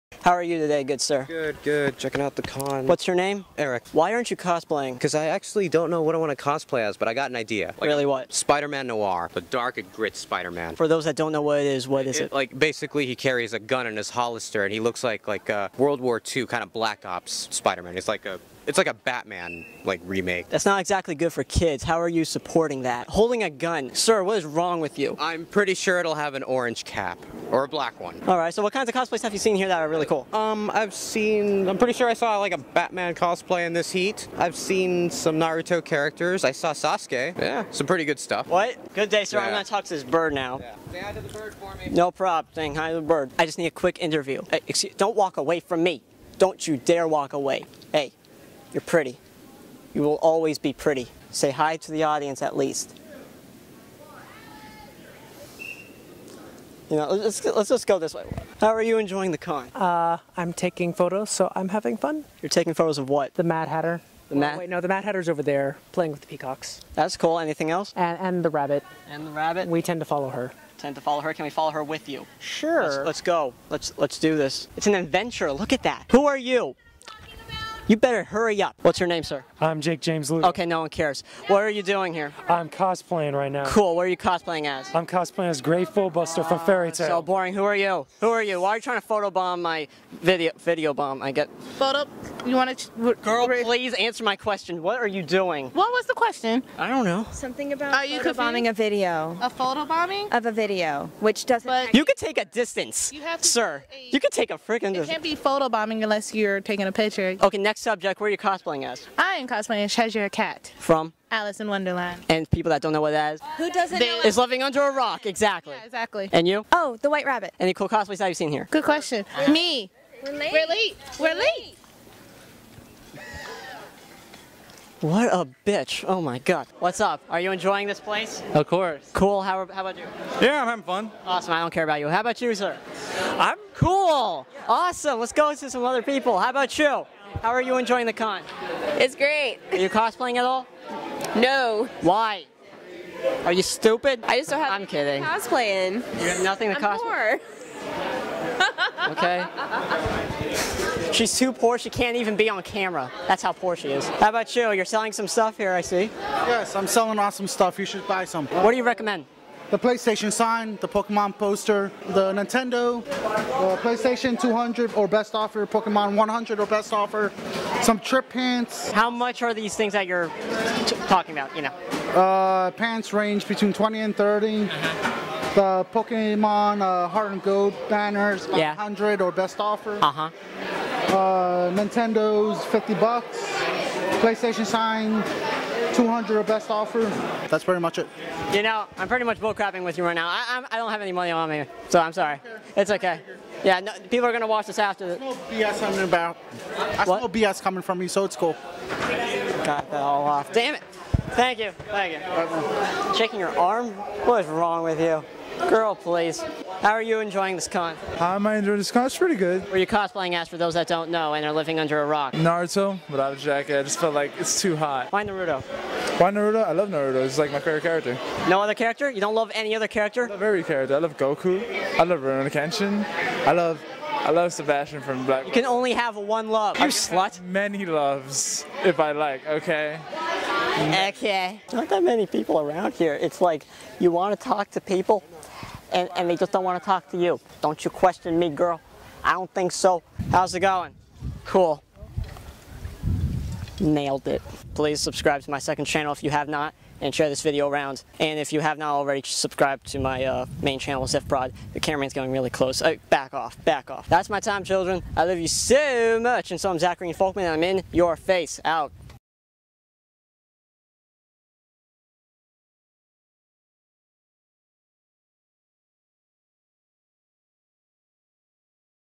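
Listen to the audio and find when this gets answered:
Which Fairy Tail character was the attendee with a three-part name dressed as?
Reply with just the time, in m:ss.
1:25.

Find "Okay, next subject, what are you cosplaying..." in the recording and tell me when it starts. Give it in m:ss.
1:47.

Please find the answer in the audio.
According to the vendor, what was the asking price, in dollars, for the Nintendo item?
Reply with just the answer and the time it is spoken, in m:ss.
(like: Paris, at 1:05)
50, at 3:02.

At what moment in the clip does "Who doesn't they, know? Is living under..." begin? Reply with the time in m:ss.
1:53.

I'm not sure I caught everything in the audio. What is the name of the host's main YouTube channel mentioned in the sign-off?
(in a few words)
Zifprod.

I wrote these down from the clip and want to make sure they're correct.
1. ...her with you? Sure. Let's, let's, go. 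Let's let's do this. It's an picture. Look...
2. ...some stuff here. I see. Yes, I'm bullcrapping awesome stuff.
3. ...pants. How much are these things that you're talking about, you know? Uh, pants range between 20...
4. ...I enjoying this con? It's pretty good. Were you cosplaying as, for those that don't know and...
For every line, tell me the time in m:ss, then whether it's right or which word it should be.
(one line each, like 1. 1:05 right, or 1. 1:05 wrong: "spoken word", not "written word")
1. 1:11 wrong: "adventure", not "picture"
2. 2:35 wrong: "selling", not "bullcrapping"
3. 2:48 right
4. 3:28 right.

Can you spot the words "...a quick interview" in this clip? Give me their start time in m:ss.
0:43.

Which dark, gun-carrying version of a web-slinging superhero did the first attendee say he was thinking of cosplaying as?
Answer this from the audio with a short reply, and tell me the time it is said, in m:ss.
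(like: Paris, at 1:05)
Spider-Man Noir, at 0:08.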